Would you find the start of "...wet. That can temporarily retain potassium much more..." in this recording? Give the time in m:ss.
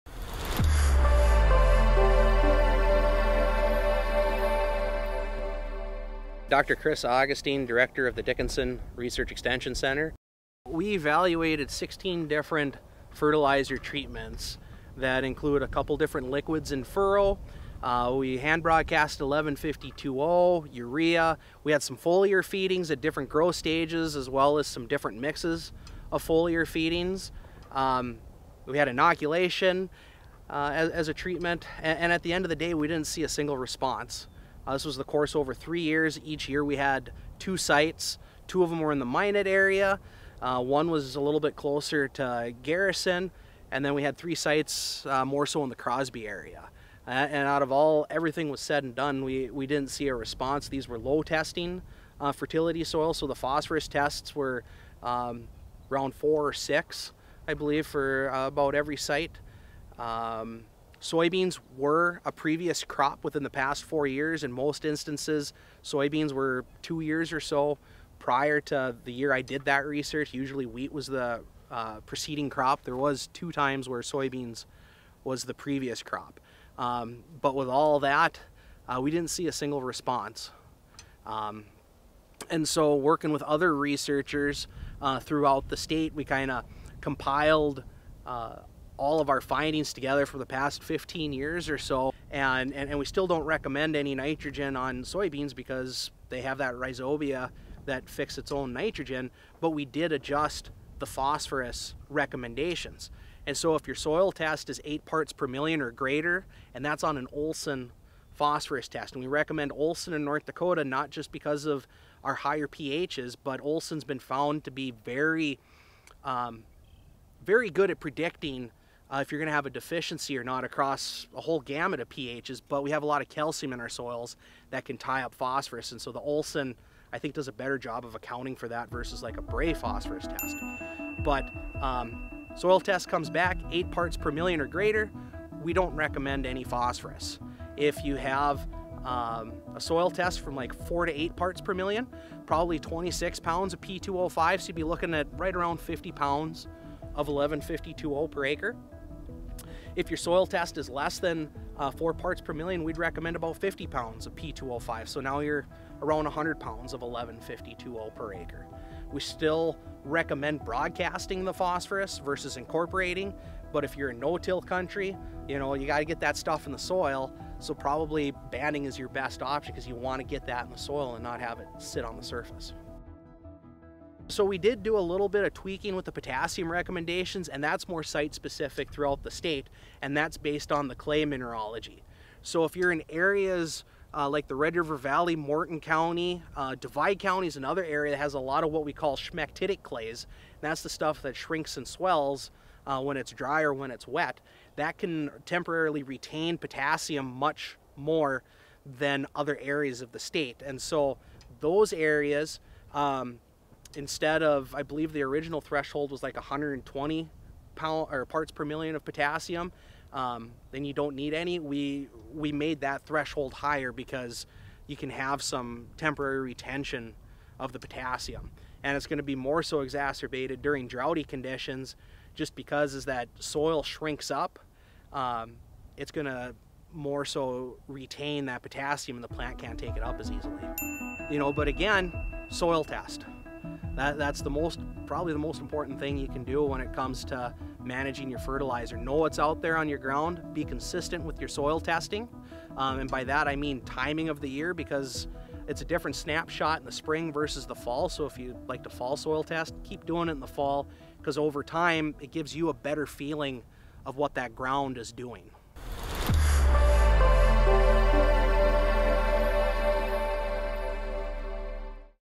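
3:14.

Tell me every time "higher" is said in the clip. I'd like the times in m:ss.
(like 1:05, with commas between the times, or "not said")
1:52, 3:33.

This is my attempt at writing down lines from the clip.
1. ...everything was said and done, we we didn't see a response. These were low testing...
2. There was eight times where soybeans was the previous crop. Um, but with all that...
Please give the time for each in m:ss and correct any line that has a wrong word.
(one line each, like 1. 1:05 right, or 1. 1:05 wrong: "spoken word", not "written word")
1. 0:48 right
2. 1:12 wrong: "two", not "eight".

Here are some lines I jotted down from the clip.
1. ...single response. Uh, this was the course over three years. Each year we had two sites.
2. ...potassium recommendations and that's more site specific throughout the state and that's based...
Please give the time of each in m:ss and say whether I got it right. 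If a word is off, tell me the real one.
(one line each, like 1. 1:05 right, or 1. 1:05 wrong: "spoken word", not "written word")
1. 0:33 right
2. 2:56 right.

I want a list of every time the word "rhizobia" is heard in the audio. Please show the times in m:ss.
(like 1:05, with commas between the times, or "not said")
1:36.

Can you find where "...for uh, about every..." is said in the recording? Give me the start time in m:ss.
0:57.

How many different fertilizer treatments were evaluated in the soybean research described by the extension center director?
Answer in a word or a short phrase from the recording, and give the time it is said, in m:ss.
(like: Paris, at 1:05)
16, at 0:11.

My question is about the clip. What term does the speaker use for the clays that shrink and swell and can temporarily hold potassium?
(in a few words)
smectitic clays.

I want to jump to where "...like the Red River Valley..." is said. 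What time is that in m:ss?
3:04.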